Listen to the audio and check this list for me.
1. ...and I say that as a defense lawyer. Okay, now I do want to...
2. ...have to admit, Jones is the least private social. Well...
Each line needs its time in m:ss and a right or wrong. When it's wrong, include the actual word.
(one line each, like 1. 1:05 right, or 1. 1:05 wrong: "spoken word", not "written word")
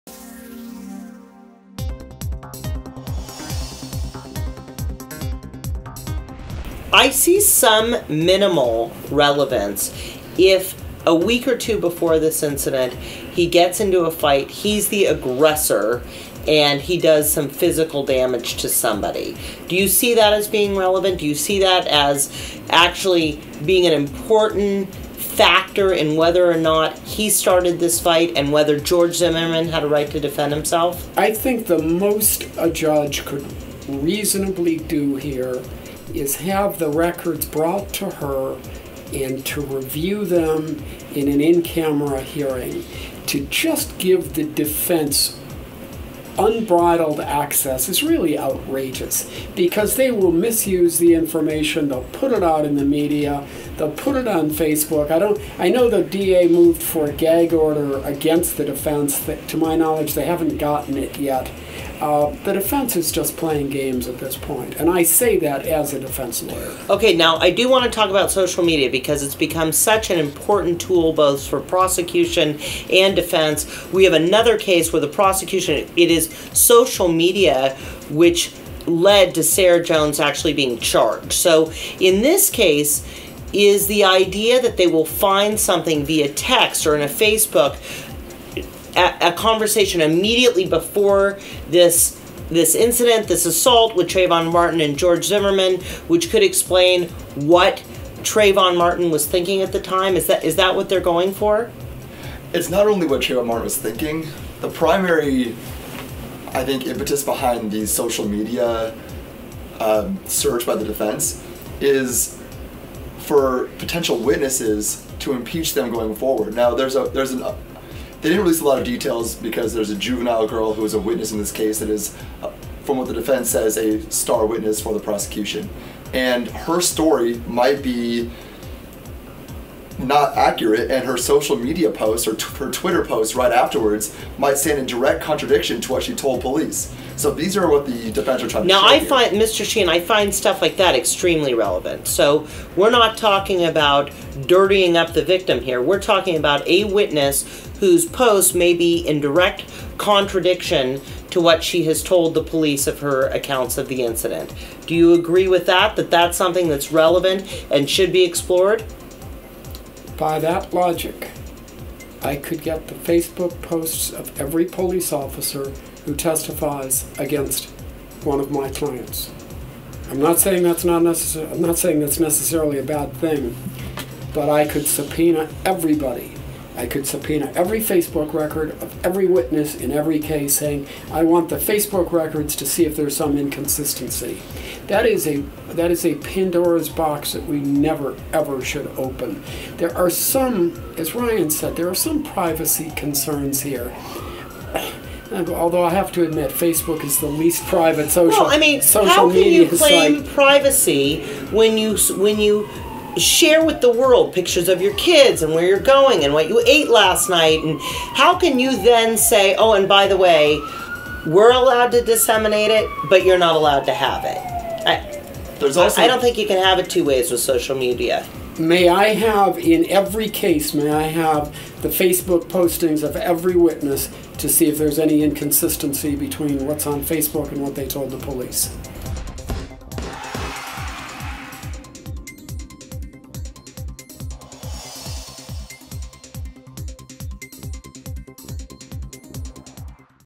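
1. 1:04 right
2. 3:15 wrong: "Facebook", not "Jones".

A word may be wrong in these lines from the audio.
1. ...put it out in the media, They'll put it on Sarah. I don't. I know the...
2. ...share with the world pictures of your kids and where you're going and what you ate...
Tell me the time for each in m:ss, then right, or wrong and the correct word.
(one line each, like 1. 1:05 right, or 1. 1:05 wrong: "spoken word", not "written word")
1. 0:52 wrong: "Facebook", not "Sarah"
2. 3:23 right.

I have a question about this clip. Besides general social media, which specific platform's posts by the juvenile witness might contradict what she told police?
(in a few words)
Twitter.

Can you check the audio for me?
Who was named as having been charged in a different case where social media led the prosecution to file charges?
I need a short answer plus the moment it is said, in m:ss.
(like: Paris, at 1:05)
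Sarah Jones, at 1:19.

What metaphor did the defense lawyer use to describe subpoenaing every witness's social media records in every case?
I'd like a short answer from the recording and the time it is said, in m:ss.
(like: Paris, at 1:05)
Pandora's box, at 3:06.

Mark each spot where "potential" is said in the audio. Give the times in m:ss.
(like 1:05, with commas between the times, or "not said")
1:53.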